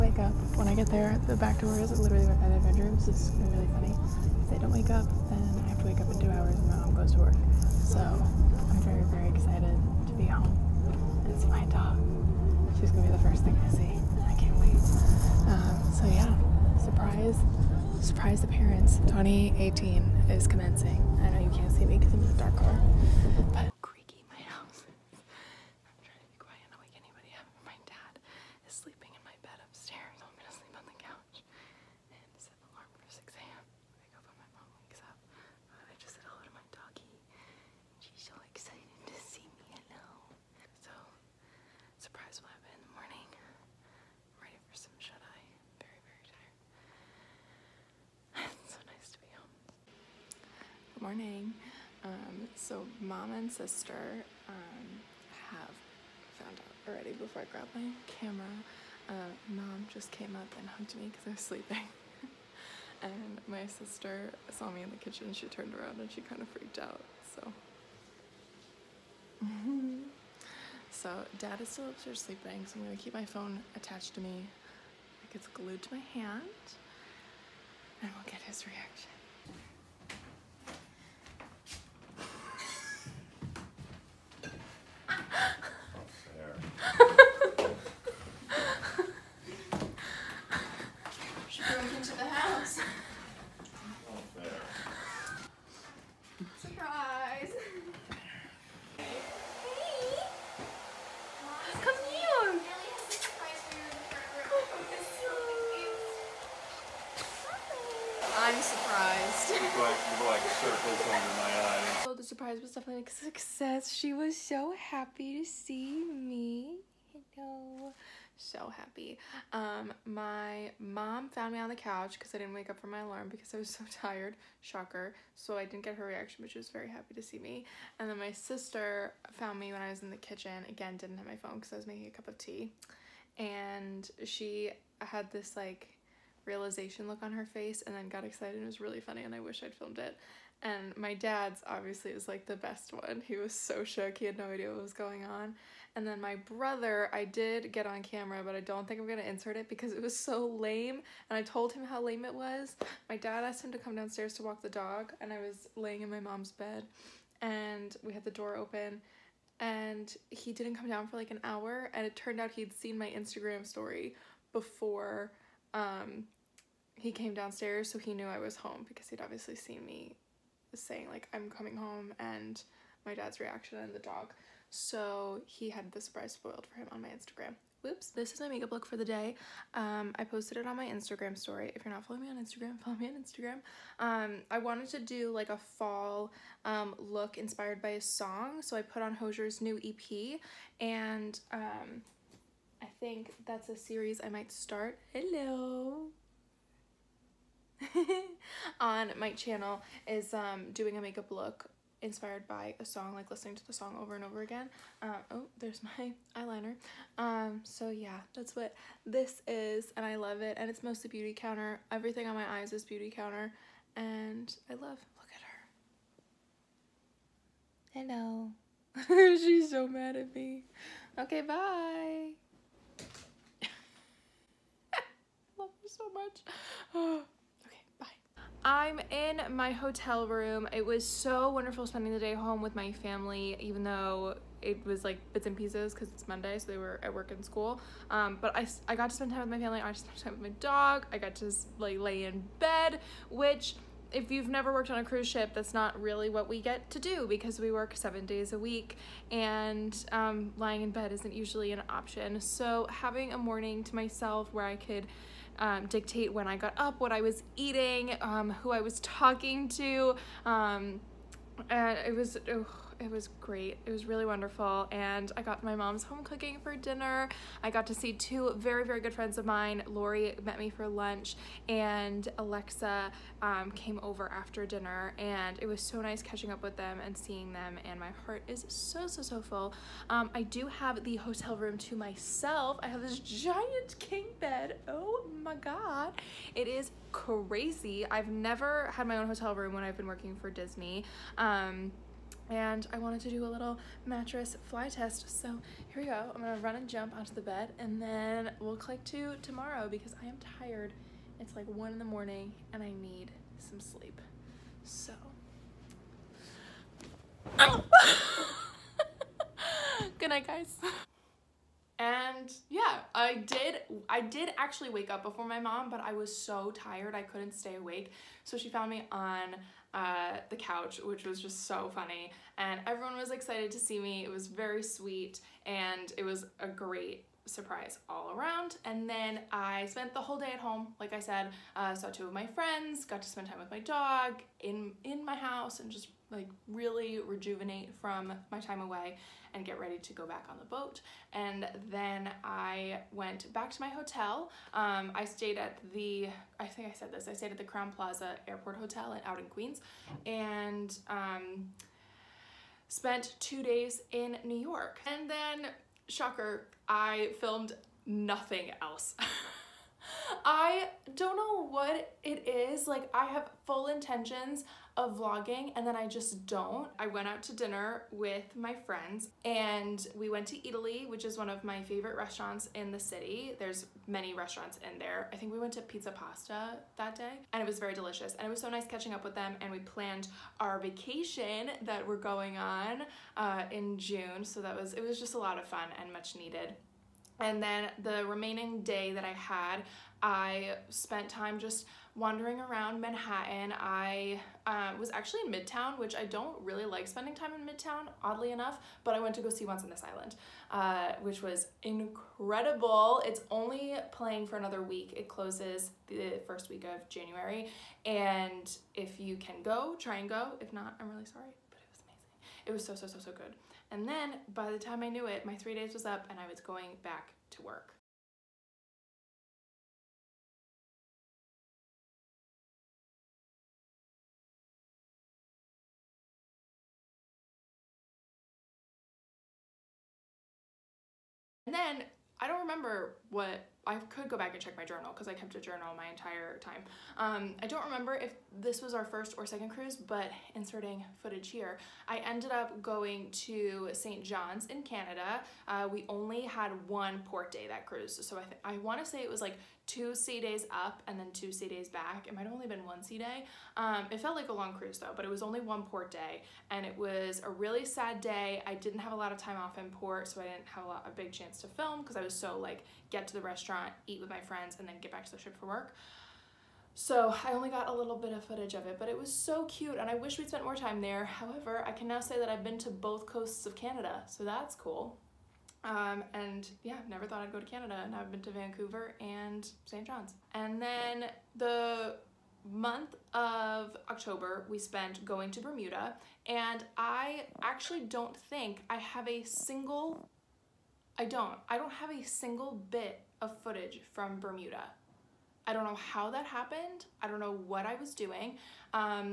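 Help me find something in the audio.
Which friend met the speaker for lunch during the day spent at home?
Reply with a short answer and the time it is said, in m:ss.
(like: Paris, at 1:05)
Lori, at 4:29.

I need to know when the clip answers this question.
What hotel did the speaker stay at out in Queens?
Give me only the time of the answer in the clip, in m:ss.
5:47.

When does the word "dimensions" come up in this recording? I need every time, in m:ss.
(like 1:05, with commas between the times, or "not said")
not said.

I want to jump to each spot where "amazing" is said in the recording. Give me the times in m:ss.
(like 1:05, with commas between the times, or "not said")
6:52.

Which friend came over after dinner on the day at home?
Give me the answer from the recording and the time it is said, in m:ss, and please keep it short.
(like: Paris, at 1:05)
Alexa, at 4:32.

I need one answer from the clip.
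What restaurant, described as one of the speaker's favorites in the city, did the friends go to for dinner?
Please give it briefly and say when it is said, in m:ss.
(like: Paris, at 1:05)
Eataly, at 6:10.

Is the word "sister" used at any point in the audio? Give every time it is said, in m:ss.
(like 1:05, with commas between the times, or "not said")
0:53, 1:03, 2:08.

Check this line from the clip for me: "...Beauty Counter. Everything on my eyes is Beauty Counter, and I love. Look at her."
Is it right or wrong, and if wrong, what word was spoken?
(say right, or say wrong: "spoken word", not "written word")
right.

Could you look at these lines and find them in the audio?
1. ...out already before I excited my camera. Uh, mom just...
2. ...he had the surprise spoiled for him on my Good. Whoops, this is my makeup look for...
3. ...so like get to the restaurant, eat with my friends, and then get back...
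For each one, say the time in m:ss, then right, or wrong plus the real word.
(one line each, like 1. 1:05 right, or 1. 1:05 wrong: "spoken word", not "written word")
1. 0:56 wrong: "grabbed", not "excited"
2. 2:55 wrong: "Instagram", not "Good"
3. 7:42 right.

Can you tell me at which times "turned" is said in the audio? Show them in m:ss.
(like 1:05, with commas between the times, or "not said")
1:05, 2:42.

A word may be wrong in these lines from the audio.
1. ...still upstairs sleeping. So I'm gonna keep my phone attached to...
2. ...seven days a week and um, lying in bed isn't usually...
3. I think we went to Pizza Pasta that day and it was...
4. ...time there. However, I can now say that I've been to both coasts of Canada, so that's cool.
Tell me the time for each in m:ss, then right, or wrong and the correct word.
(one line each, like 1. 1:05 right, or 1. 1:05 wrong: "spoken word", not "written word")
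1. 1:11 right
2. 4:07 right
3. 6:15 right
4. 7:50 right.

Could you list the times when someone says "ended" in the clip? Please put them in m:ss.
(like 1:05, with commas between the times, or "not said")
7:22.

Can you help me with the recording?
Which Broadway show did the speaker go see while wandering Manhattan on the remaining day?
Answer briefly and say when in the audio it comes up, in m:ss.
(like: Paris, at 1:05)
Once on This Island, at 6:39.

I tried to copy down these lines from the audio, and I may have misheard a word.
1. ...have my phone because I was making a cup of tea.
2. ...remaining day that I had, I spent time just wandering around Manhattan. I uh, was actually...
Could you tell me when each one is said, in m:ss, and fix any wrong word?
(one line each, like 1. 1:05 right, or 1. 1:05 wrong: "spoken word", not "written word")
1. 2:11 right
2. 6:28 right.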